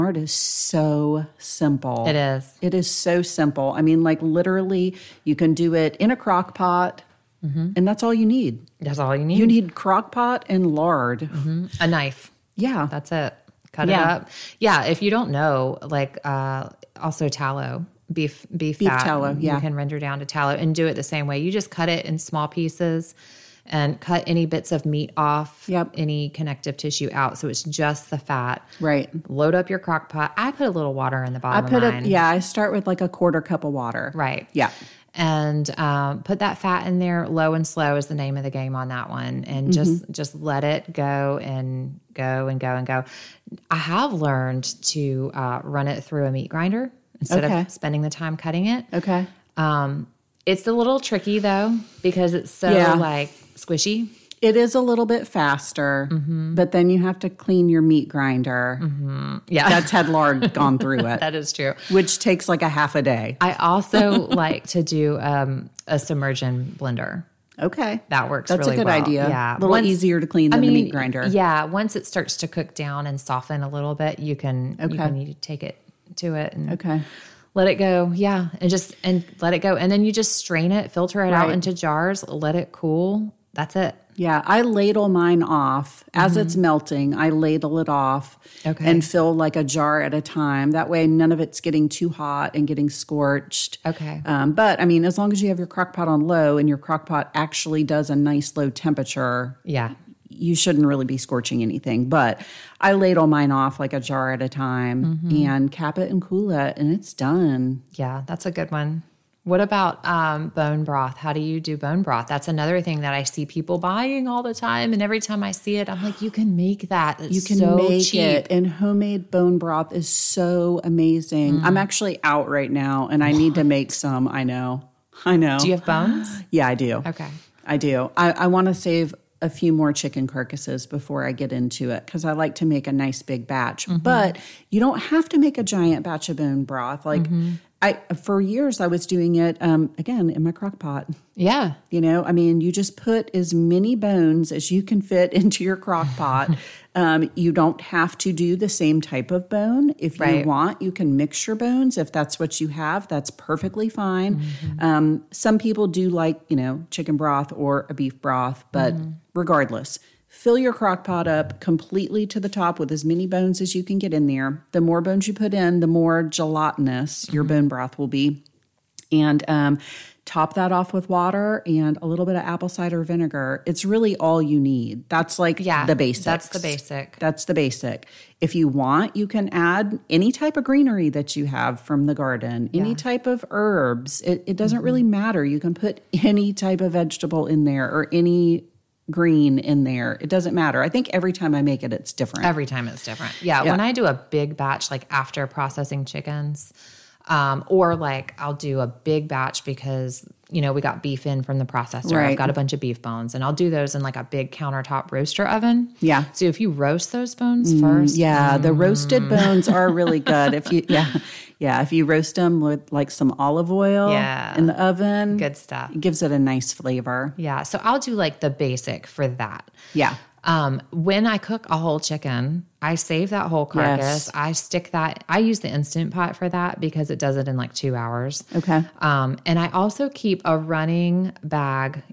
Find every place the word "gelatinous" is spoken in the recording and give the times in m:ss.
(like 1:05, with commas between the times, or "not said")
2:46.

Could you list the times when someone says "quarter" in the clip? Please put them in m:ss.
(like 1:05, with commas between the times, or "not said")
0:33.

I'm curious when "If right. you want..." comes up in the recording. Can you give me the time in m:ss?
2:29.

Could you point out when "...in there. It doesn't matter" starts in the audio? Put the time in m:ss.
3:09.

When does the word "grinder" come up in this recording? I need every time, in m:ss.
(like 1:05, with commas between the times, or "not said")
0:46, 0:58, 1:10.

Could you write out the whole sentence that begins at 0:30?
I put a little water in the bottom.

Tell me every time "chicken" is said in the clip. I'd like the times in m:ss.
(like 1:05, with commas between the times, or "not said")
2:09, 2:36, 3:16, 3:42.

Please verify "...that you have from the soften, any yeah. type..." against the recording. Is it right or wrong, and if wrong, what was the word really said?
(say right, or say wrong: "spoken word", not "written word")
wrong: "garden", not "soften".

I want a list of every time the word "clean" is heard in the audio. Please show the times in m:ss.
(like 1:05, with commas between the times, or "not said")
0:57, 1:10.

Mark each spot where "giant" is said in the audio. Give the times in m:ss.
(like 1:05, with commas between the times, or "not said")
2:15.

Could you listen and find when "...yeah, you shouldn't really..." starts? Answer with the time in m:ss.
1:39.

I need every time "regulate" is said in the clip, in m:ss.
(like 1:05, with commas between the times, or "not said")
not said.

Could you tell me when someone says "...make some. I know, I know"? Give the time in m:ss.
2:03.